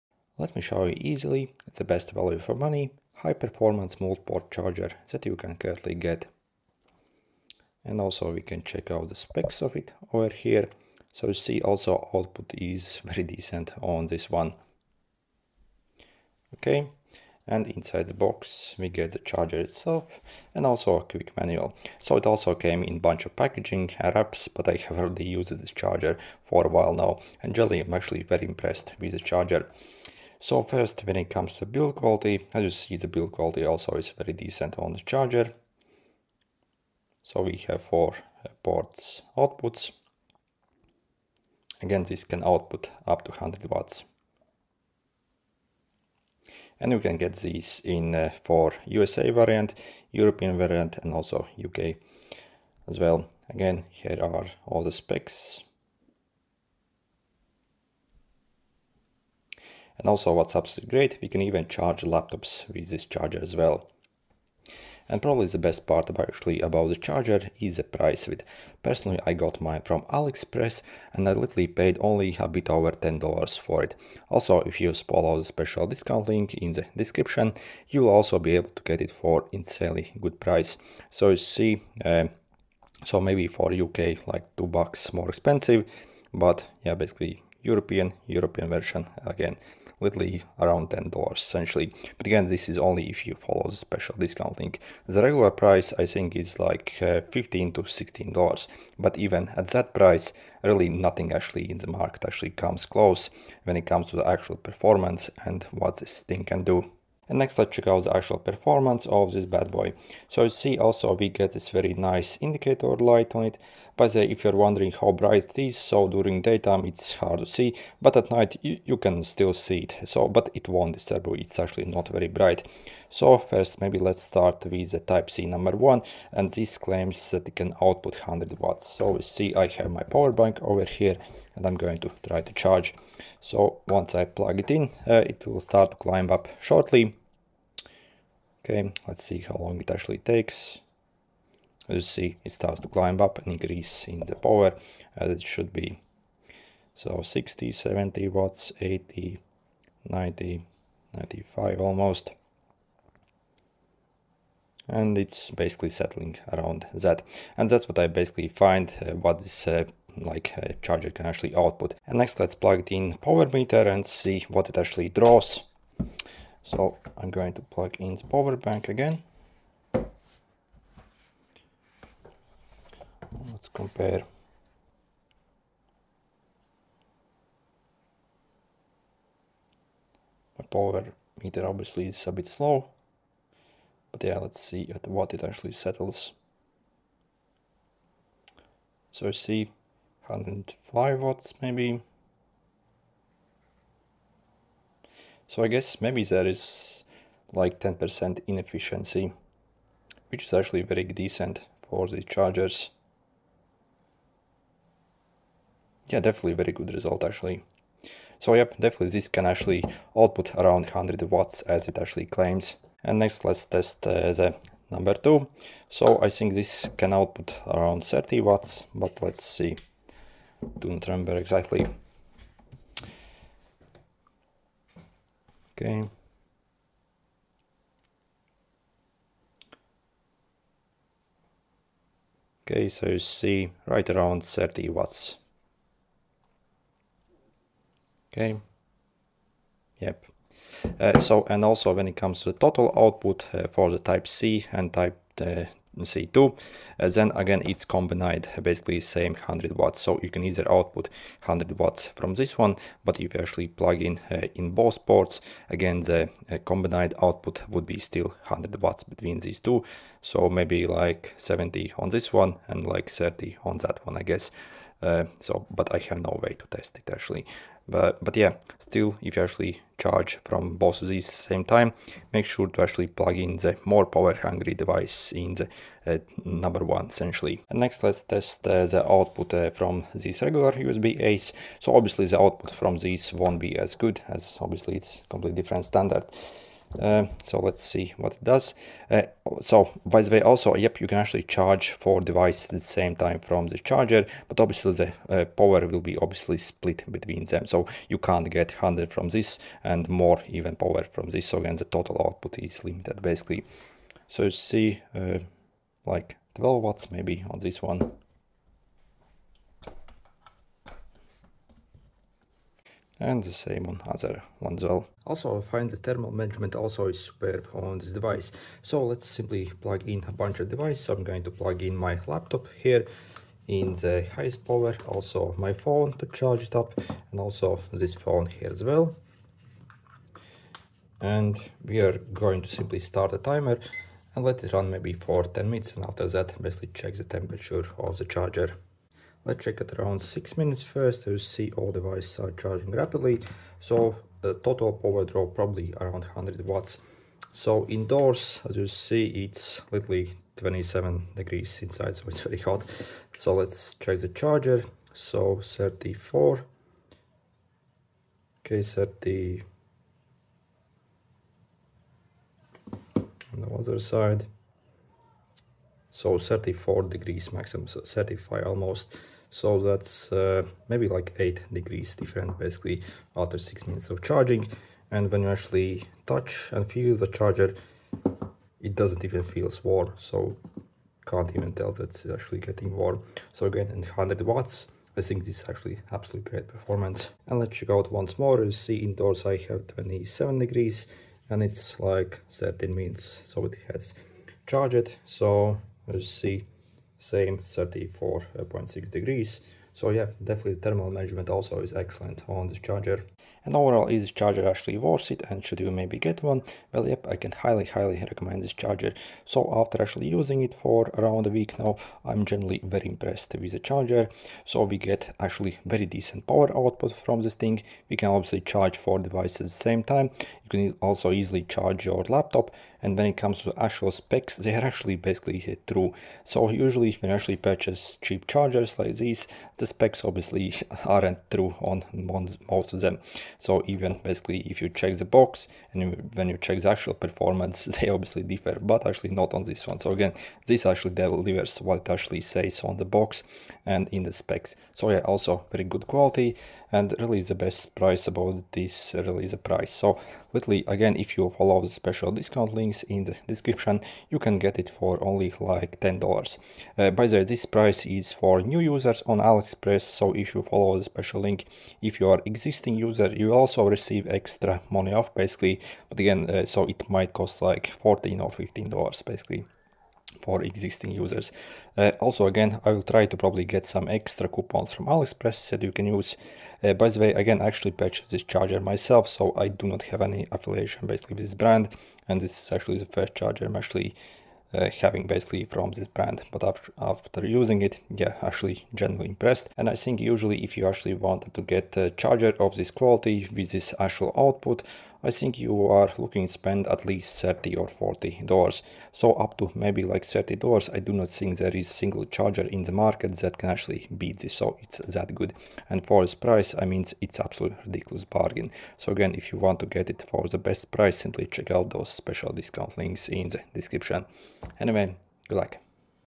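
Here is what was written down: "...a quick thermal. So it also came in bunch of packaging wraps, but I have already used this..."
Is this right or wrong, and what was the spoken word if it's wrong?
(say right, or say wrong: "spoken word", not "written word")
wrong: "manual", not "thermal".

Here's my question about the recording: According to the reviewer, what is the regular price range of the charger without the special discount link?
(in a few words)
$15 to $16.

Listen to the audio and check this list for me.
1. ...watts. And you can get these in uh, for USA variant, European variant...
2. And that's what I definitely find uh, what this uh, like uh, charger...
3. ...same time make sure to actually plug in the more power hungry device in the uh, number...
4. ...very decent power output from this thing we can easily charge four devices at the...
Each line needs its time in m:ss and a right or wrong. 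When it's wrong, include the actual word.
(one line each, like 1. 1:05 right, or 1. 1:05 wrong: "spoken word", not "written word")
1. 0:43 right
2. 2:37 wrong: "basically", not "definitely"
3. 4:31 right
4. 6:55 wrong: "obviously", not "easily".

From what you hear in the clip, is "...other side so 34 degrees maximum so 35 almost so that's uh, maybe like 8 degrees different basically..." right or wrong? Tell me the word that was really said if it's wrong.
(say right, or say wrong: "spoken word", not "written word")
right.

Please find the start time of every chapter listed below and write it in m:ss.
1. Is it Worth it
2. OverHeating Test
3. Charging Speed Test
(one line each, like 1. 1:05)
1. 6:43
2. 5:15
3. 1:47.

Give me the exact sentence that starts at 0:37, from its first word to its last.
So we have four ports outputs.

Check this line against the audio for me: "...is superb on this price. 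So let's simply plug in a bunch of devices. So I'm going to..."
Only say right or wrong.
wrong.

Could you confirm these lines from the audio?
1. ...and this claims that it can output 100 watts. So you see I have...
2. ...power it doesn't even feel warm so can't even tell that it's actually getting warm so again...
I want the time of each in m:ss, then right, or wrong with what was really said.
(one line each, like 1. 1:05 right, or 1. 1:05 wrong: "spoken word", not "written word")
1. 2:06 right
2. 6:17 wrong: "charger", not "power".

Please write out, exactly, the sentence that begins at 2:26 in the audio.
So 60, 70 watts, 80, 90, 95 almost.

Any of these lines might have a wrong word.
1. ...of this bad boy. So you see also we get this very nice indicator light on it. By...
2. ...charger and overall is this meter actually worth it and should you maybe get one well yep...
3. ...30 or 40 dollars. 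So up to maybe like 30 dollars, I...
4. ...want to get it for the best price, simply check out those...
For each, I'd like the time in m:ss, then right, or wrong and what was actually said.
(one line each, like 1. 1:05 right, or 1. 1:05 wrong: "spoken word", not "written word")
1. 1:49 right
2. 6:42 wrong: "charger", not "meter"
3. 8:17 right
4. 8:29 right.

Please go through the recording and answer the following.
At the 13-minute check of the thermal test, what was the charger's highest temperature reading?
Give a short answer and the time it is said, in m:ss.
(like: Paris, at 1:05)
34.6 degrees, at 6:37.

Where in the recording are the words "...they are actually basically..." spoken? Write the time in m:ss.
7:04.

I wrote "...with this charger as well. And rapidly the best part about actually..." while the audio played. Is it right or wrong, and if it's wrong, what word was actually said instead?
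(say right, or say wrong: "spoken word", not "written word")
wrong: "probably", not "rapidly".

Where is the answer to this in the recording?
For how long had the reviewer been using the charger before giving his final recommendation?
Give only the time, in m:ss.
6:51.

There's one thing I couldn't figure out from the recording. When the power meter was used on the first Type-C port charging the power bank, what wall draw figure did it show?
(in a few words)
105 watts.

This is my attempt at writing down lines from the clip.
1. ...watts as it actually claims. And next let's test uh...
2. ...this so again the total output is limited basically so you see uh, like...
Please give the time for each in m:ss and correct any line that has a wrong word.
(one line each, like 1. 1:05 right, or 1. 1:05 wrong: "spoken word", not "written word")
1. 3:31 right
2. 5:01 right.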